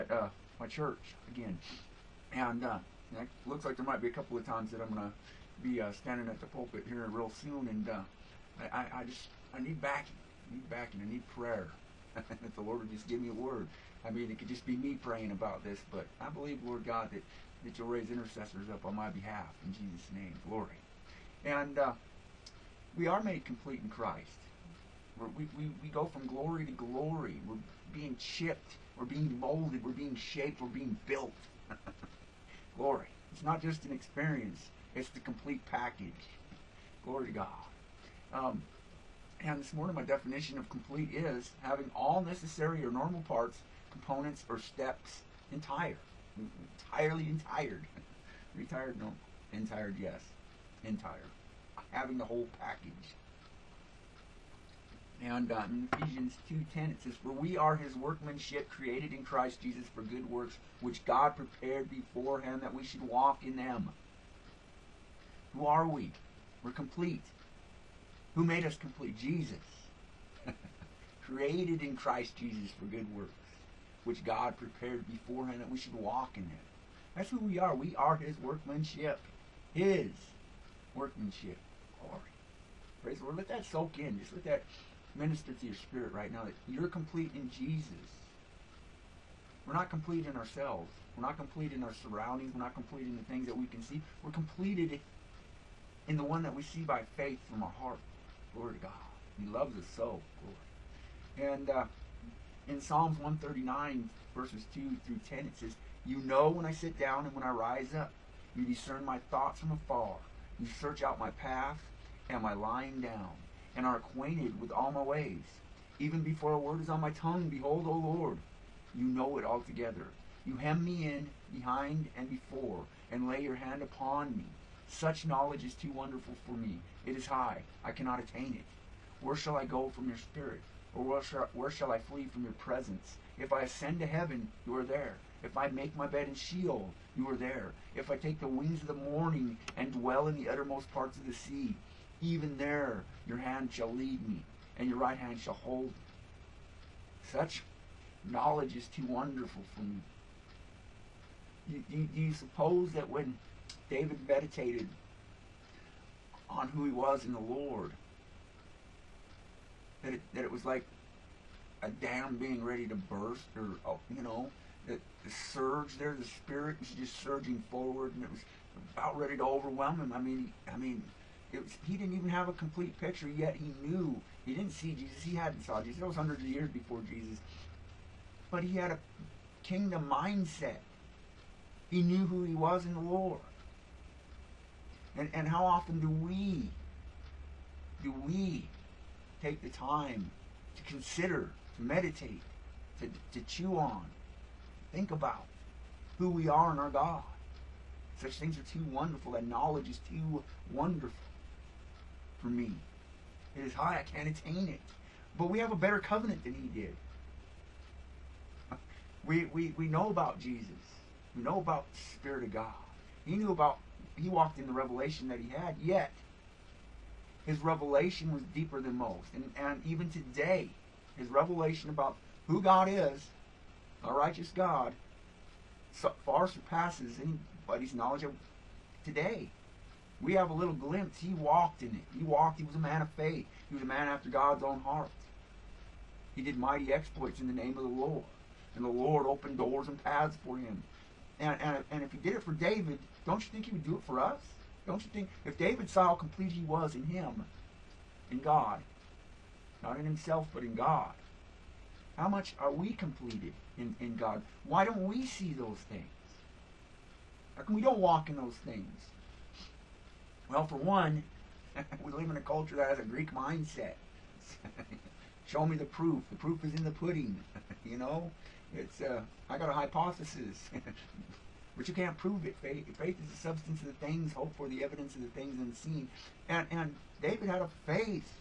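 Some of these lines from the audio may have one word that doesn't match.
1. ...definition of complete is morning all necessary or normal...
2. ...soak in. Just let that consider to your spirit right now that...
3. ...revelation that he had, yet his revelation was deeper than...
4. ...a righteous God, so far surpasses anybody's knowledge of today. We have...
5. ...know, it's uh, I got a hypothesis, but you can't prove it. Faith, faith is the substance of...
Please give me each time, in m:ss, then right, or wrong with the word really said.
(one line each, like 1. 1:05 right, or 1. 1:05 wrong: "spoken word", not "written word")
1. 0:40 wrong: "having", not "morning"
2. 1:23 wrong: "minister", not "consider"
3. 3:34 right
4. 3:44 right
5. 4:27 right.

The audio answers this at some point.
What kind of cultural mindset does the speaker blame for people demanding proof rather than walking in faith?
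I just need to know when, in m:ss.
4:23.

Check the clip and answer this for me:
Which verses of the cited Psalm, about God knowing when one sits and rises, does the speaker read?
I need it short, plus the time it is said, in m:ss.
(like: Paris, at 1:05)
2 through 10, at 1:44.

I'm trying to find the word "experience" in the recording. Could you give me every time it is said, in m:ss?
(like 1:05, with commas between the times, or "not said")
0:33.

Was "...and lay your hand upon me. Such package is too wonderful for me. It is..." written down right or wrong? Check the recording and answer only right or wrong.
wrong.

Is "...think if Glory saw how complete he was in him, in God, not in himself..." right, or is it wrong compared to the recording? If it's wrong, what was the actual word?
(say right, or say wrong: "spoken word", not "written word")
wrong: "David", not "Glory".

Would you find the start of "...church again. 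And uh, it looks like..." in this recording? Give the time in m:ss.
0:00.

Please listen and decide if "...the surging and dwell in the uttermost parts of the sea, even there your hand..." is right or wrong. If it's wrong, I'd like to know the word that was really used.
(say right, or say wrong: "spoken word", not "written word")
wrong: "morning", not "surging".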